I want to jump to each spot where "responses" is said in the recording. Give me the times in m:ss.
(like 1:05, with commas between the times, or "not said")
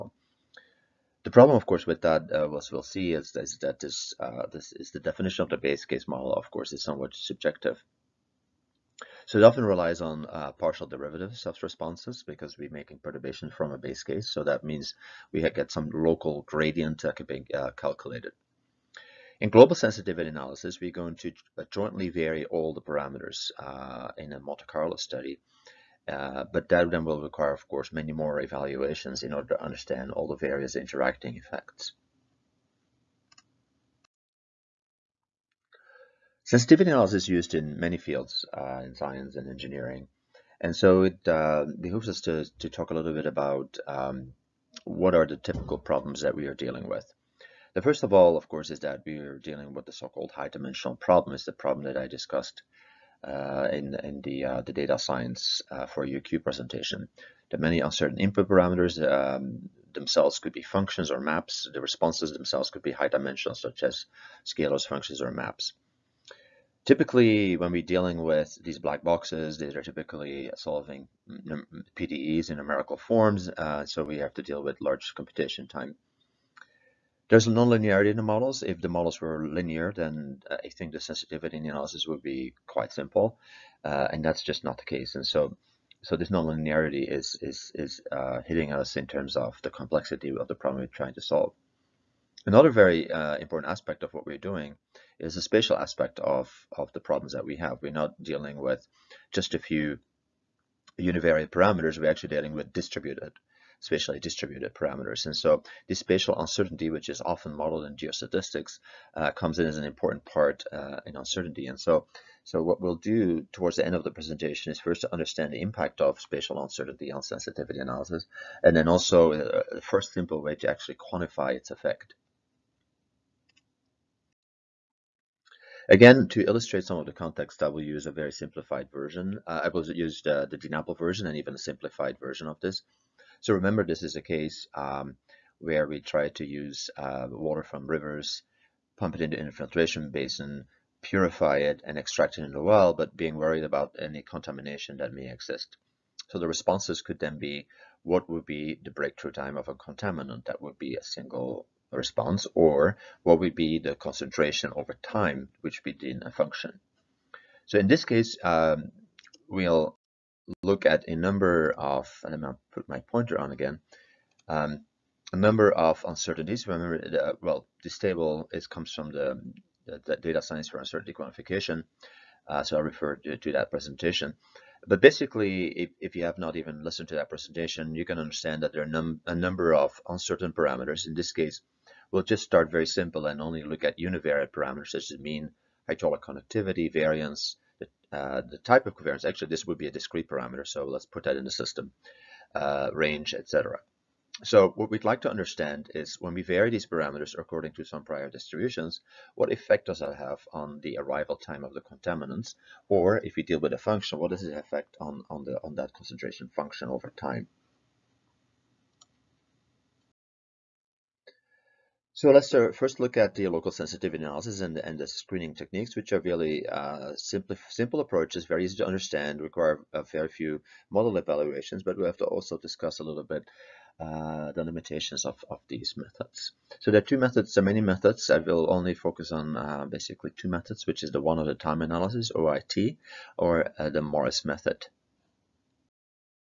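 0:11, 1:01, 2:26, 2:31.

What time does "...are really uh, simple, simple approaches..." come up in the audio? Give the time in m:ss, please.
3:36.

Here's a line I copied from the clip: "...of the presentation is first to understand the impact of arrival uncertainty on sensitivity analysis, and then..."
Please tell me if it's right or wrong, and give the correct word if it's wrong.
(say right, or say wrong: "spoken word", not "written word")
wrong: "spatial", not "arrival".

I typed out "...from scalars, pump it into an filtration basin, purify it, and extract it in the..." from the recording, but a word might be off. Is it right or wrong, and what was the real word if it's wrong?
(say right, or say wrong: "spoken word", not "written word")
wrong: "rivers", not "scalars".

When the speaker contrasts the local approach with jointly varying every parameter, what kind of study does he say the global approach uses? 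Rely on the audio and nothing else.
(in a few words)
Monte Carlo study.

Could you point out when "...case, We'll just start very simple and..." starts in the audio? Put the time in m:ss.
3:01.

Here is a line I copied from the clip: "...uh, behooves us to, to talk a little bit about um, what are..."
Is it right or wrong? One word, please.
right.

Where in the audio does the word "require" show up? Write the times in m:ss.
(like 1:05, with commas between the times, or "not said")
0:27, 3:39.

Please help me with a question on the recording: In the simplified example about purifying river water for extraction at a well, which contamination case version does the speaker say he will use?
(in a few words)
DNAPL.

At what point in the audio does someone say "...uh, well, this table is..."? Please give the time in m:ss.
2:47.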